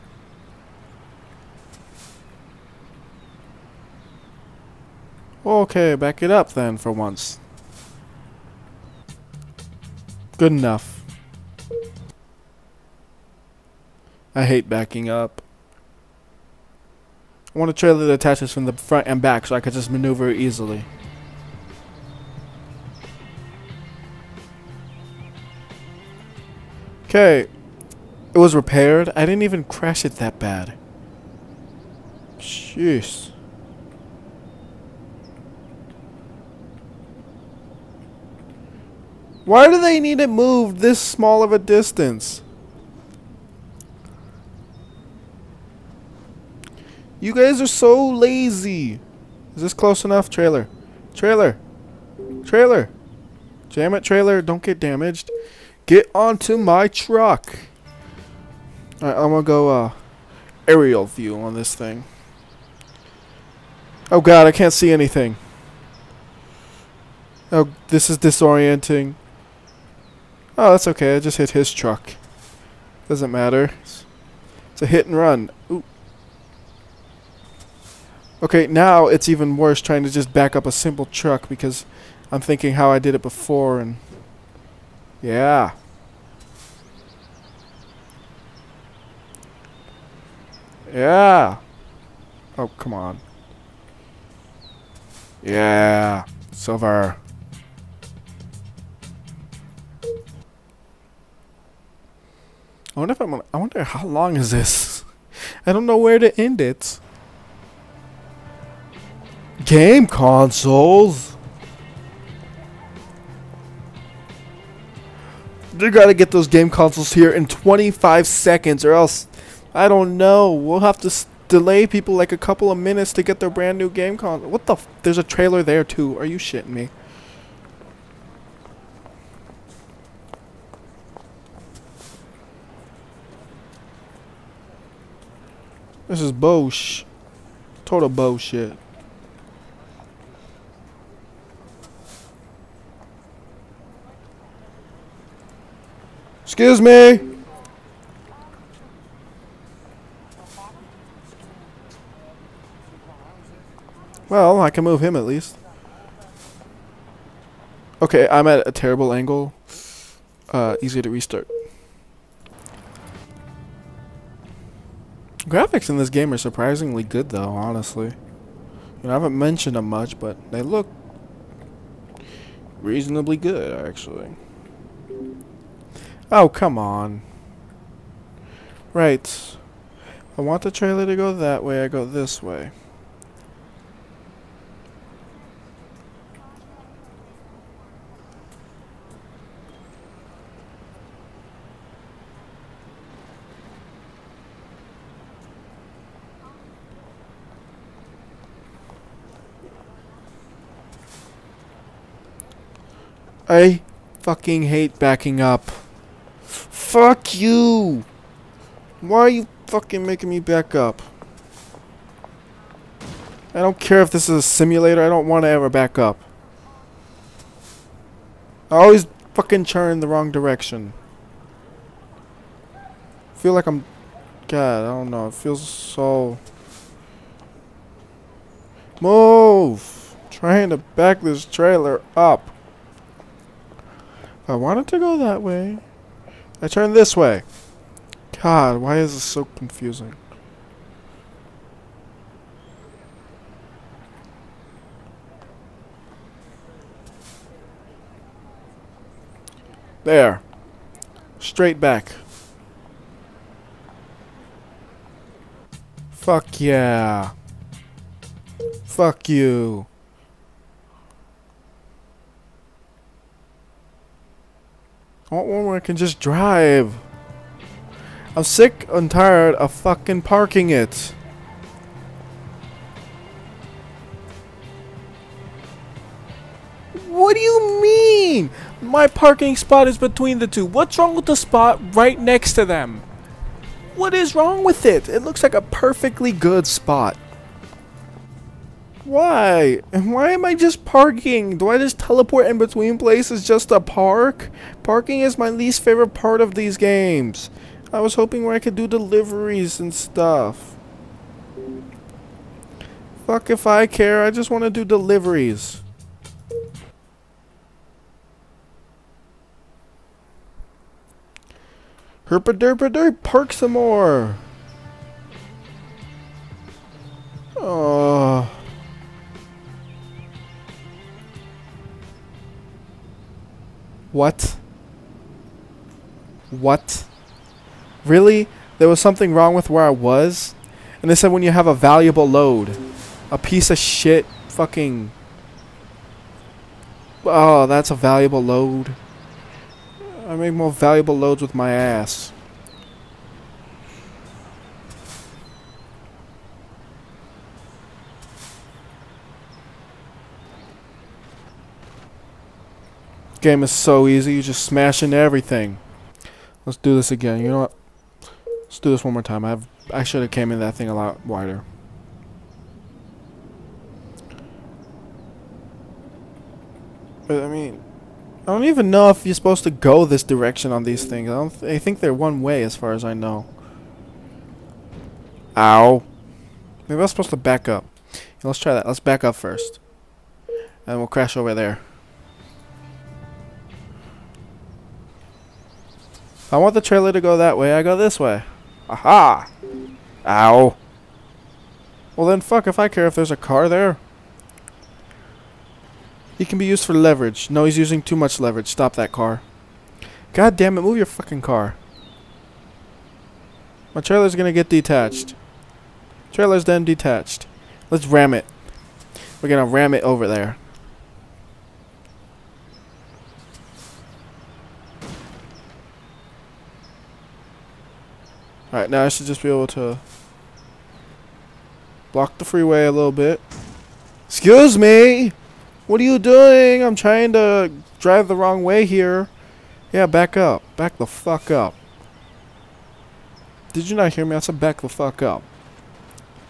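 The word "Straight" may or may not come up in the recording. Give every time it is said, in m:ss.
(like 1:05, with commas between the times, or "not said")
4:11.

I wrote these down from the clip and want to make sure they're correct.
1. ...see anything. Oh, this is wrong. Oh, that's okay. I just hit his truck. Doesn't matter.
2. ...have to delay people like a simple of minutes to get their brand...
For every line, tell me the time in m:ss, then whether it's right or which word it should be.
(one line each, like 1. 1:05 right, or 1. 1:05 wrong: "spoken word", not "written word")
1. 1:04 wrong: "disorienting", not "wrong"
2. 2:00 wrong: "couple", not "simple".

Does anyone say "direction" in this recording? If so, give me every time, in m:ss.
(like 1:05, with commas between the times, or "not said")
3:40, 6:10.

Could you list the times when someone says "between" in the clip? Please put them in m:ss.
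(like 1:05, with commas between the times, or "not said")
4:39, 4:52.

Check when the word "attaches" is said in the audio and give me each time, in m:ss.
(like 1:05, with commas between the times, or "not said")
0:18.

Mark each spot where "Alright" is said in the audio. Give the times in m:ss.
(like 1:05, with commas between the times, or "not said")
0:59, 6:58.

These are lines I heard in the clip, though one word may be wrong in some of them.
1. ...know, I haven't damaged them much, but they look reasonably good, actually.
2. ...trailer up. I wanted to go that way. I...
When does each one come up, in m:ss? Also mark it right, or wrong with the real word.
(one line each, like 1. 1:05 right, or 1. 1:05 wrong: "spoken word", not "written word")
1. 2:49 wrong: "mentioned", not "damaged"
2. 3:51 right.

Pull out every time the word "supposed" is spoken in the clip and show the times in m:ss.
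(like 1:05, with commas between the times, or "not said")
6:09, 6:17.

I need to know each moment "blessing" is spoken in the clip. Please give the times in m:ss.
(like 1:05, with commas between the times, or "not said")
not said.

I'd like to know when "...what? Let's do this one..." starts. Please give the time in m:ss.
5:57.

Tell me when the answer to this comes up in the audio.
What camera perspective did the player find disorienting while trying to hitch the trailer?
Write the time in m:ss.
1:00.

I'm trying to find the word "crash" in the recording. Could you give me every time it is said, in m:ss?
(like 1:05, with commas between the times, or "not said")
0:29, 6:21.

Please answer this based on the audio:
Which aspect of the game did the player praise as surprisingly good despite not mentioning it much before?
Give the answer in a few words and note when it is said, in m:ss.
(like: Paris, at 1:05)
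Graphics, at 2:45.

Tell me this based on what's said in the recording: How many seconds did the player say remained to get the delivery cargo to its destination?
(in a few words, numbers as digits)
25.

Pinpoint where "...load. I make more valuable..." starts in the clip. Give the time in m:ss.
5:38.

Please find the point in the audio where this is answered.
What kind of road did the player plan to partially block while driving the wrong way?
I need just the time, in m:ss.
7:02.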